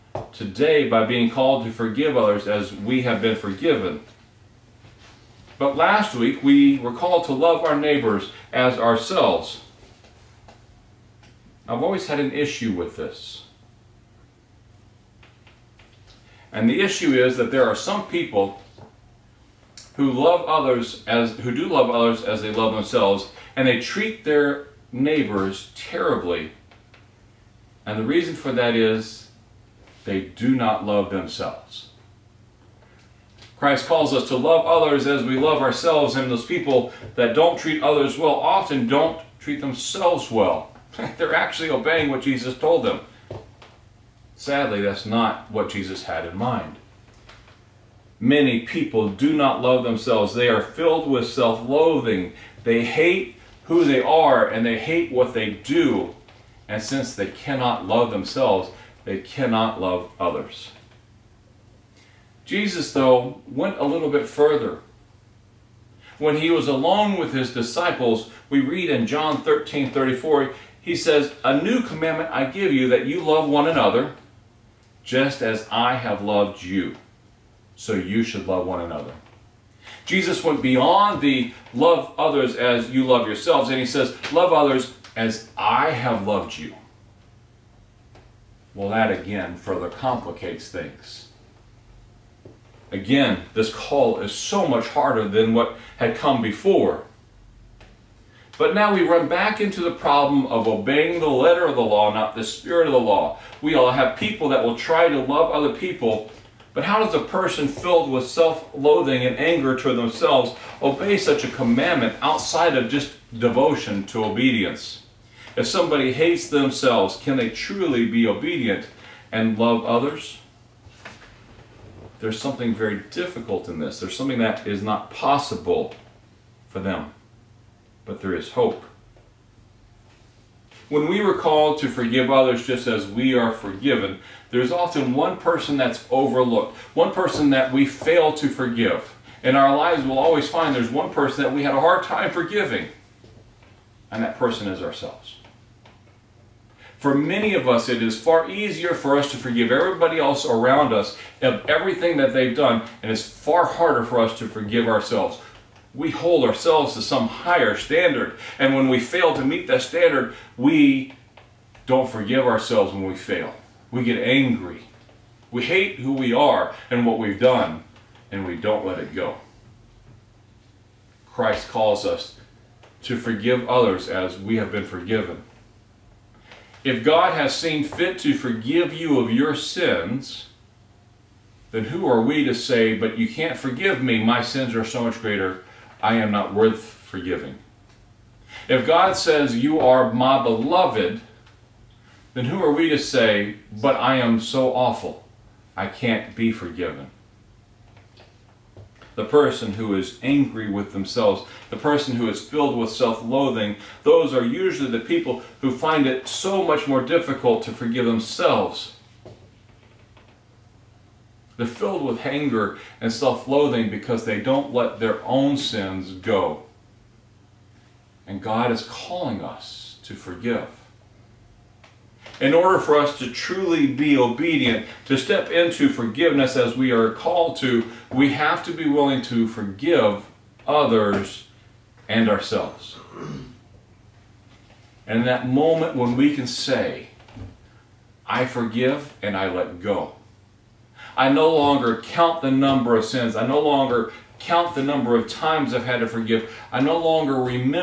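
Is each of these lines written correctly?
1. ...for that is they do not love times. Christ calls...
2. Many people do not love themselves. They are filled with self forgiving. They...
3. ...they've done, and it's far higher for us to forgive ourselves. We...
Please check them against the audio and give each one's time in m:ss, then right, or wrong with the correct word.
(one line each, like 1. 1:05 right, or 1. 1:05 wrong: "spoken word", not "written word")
1. 0:28 wrong: "themselves", not "times"
2. 0:48 wrong: "loathing", not "forgiving"
3. 2:32 wrong: "harder", not "higher".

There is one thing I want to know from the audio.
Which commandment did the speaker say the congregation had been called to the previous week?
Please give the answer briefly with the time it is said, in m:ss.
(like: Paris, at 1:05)
Love our neighbors as ourselves, at 0:07.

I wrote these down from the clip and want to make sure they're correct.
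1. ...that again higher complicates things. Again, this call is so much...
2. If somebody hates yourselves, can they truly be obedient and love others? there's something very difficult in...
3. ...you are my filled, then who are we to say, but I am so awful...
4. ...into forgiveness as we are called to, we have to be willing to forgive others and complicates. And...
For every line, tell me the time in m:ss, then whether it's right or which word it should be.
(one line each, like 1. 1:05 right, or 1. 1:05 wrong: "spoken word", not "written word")
1. 1:28 wrong: "further", not "higher"
2. 1:55 wrong: "themselves", not "yourselves"
3. 3:09 wrong: "beloved", not "filled"
4. 3:45 wrong: "ourselves", not "complicates".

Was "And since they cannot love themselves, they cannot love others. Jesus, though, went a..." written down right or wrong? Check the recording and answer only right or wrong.
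right.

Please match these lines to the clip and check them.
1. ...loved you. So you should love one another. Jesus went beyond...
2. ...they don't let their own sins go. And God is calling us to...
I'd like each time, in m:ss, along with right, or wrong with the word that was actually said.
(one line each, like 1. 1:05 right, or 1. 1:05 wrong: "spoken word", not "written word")
1. 1:16 right
2. 3:34 right.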